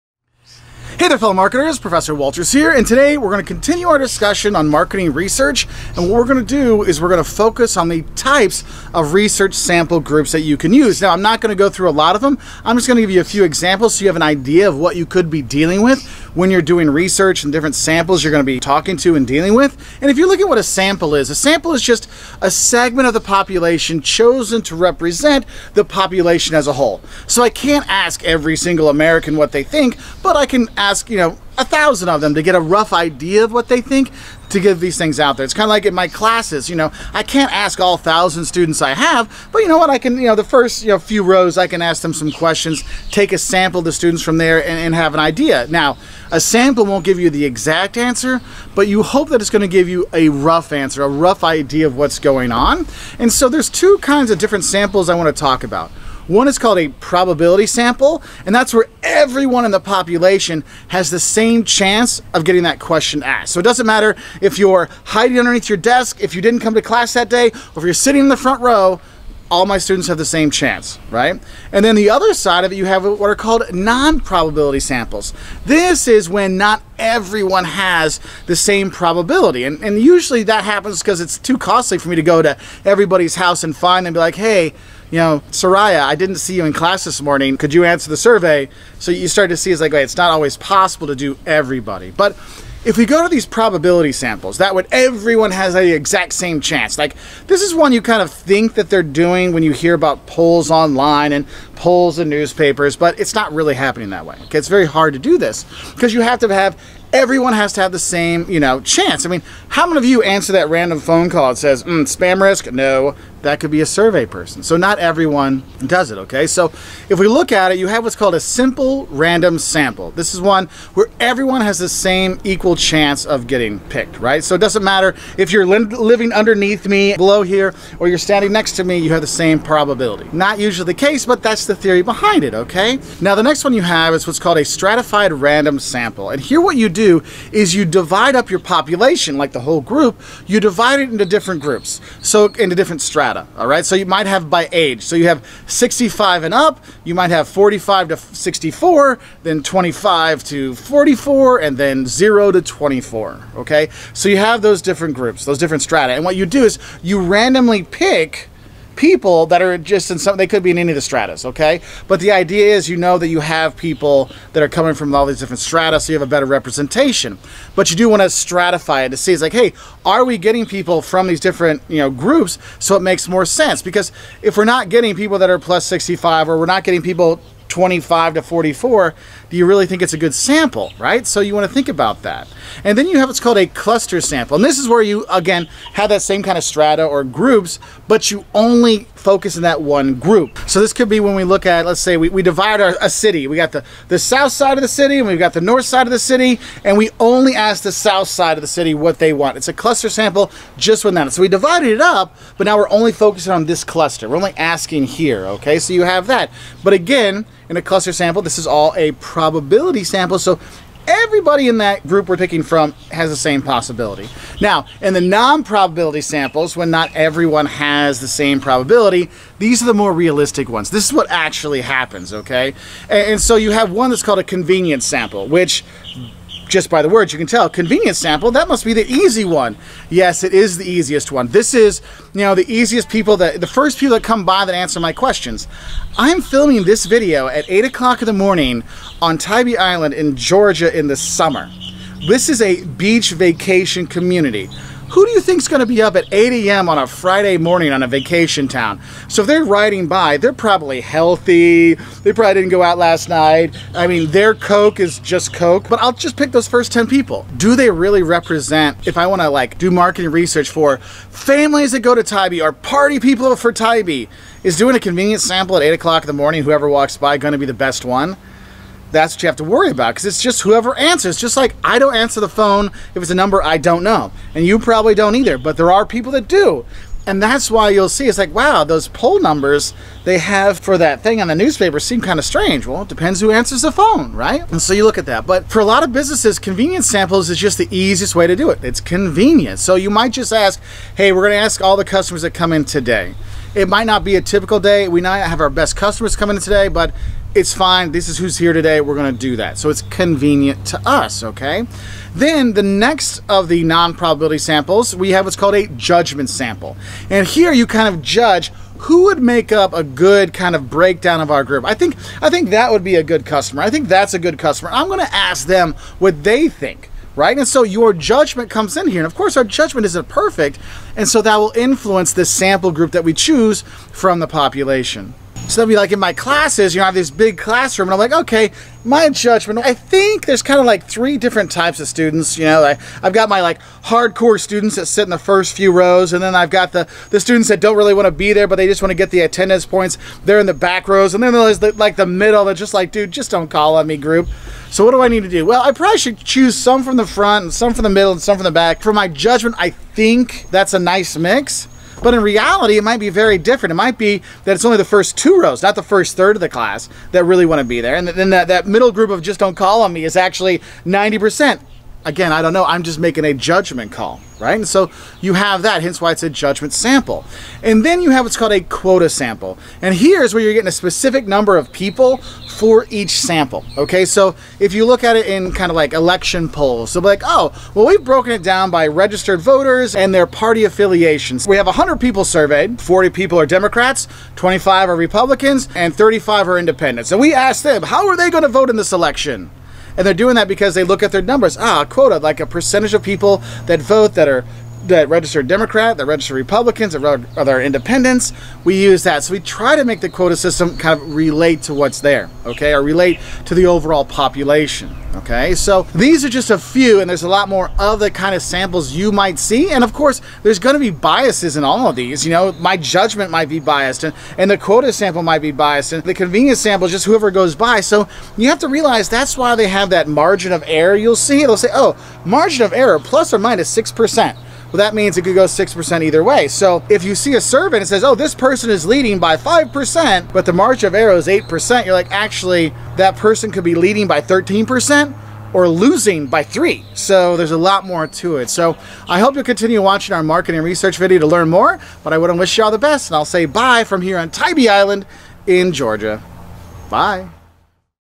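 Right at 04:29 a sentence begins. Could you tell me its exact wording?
that's what you have to worry about because it's just whoever answers.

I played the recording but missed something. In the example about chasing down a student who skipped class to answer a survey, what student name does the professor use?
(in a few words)
Soraya.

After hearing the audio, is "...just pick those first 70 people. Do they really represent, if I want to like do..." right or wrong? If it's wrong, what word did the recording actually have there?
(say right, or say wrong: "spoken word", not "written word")
wrong: "10", not "70".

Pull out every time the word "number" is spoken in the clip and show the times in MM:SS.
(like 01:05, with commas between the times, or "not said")
04:33, 04:39, 06:11, 06:31.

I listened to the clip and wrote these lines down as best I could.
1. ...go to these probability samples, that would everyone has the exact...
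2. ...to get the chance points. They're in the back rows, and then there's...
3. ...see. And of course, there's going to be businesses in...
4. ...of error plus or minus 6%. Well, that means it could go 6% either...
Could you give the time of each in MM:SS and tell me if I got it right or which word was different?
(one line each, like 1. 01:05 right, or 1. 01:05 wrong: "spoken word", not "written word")
1. 01:33 right
2. 05:39 wrong: "attendance", not "chance"
3. 06:49 wrong: "biases", not "businesses"
4. 07:02 right.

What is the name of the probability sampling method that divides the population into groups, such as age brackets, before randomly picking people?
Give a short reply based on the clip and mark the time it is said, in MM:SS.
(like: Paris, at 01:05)
Stratified random sample, at 02:14.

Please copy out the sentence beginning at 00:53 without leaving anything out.
And so there's two kinds of different samples I want to talk about.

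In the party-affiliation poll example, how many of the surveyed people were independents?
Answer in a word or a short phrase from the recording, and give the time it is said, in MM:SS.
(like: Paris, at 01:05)
35, at 06:26.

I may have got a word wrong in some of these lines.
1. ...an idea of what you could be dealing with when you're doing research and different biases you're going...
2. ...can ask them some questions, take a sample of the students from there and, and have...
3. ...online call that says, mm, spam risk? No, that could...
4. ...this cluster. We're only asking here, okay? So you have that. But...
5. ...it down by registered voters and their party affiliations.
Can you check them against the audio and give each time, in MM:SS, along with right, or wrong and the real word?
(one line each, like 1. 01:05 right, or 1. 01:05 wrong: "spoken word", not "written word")
1. 00:14 wrong: "samples", not "biases"
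2. 00:41 right
3. 01:50 wrong: "phone", not "online"
4. 03:23 right
5. 06:18 right.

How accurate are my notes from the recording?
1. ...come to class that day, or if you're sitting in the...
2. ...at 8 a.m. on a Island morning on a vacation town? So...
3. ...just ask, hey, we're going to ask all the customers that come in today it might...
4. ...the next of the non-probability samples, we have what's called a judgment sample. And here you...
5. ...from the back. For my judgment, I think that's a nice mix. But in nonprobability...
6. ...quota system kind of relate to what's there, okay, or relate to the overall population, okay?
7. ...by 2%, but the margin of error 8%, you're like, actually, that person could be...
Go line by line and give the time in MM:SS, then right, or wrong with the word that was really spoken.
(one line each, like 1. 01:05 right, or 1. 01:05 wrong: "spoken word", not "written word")
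1. 01:06 right
2. 04:06 wrong: "Friday", not "Island"
3. 04:50 right
4. 05:02 right
5. 05:48 wrong: "reality", not "nonprobability"
6. 06:40 right
7. 07:09 wrong: "5", not "2".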